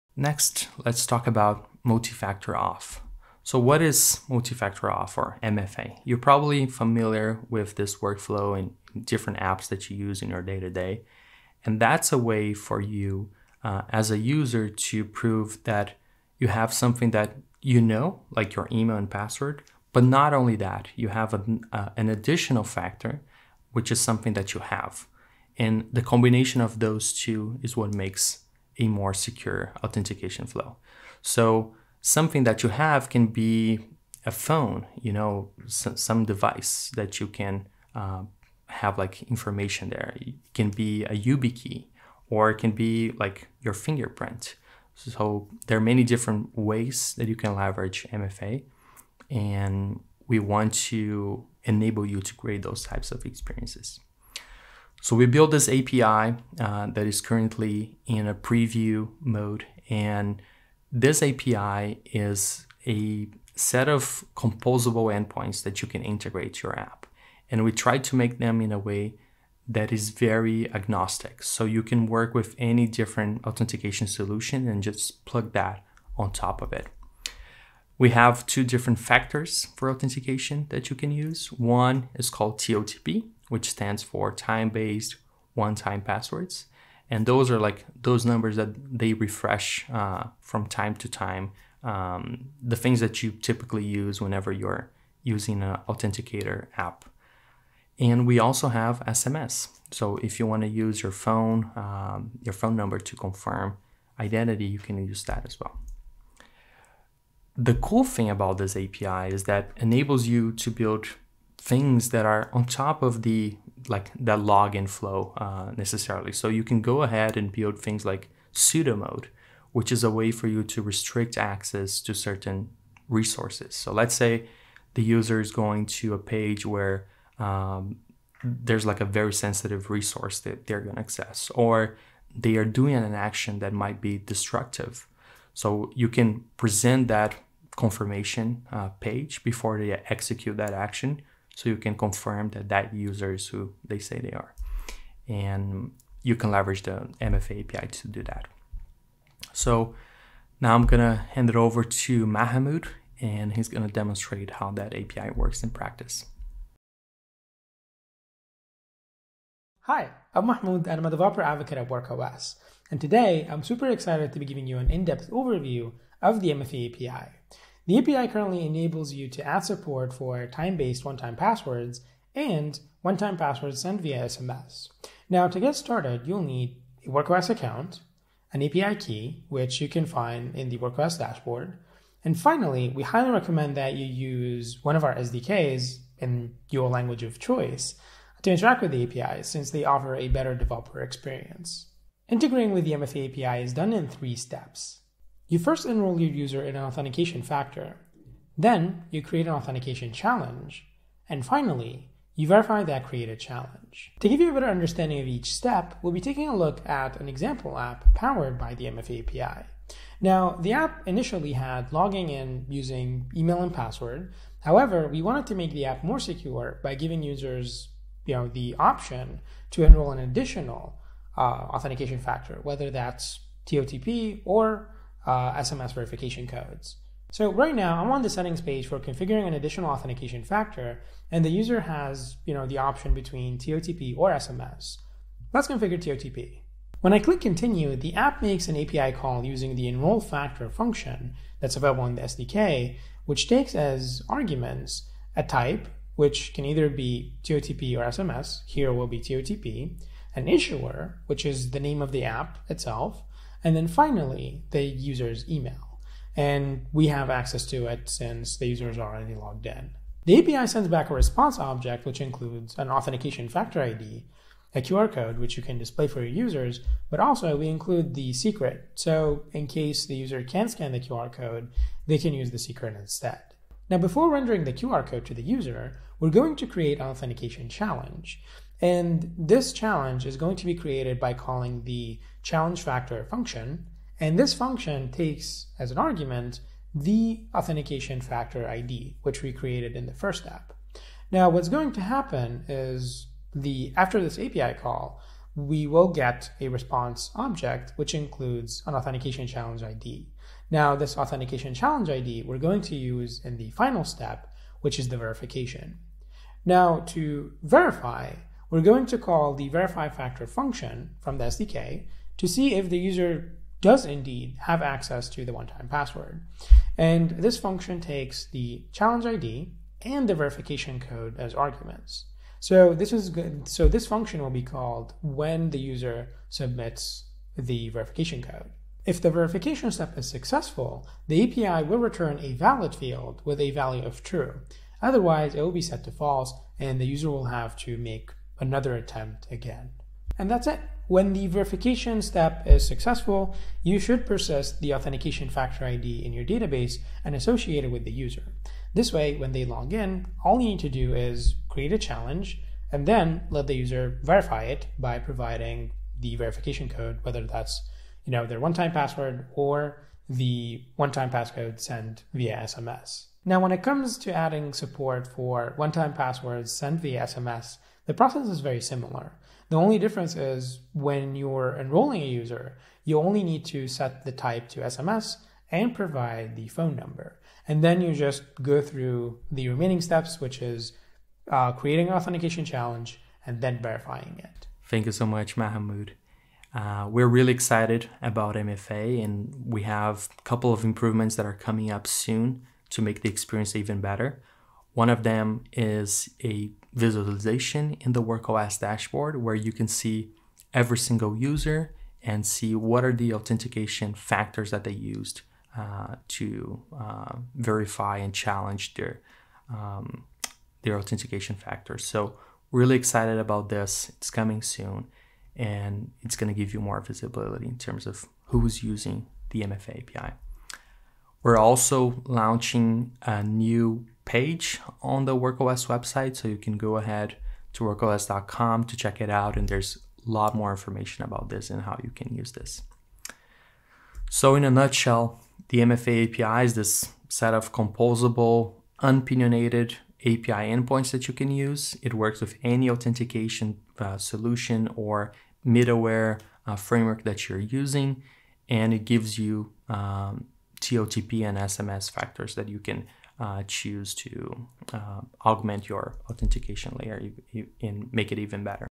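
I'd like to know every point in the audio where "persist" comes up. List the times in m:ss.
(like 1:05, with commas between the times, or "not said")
5:44.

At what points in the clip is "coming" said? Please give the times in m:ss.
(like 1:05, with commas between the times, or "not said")
6:31, 6:54.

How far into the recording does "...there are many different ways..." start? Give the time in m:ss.
0:45.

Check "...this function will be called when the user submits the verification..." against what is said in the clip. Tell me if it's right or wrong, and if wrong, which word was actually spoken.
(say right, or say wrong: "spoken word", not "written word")
right.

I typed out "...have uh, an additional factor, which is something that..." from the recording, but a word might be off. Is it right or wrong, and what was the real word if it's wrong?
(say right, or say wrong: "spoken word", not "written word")
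right.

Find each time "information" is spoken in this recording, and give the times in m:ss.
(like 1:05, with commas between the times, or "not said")
0:39, 7:10.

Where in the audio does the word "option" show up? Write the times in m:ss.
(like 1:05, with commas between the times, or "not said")
3:38, 3:52.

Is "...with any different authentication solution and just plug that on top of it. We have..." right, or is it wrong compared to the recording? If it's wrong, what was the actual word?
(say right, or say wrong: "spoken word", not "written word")
right.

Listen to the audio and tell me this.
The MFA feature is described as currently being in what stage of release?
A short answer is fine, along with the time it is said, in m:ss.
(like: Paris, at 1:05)
Preview mode, at 0:58.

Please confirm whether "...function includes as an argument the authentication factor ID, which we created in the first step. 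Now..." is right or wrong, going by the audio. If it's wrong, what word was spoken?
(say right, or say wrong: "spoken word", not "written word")
wrong: "takes", not "includes".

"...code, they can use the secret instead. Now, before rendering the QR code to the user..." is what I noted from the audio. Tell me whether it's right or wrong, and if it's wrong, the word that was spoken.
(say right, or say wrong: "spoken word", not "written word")
right.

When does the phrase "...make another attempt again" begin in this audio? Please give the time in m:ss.
5:37.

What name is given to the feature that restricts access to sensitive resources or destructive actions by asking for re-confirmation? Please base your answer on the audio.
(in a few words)
Sudo mode.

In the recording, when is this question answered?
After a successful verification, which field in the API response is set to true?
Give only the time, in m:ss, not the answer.
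5:32.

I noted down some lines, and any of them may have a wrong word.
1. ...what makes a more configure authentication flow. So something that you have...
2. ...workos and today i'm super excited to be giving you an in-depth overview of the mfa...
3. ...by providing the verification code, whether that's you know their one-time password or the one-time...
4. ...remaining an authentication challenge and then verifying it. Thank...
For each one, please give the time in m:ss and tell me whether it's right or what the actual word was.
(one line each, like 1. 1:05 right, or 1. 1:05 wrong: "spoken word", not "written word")
1. 0:27 wrong: "secure", not "configure"
2. 2:41 right
3. 5:54 right
4. 6:21 wrong: "creating", not "remaining".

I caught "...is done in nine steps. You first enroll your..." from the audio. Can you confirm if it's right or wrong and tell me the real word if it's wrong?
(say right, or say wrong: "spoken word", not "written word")
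wrong: "three", not "nine".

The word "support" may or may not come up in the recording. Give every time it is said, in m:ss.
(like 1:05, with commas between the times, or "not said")
2:49, 6:04.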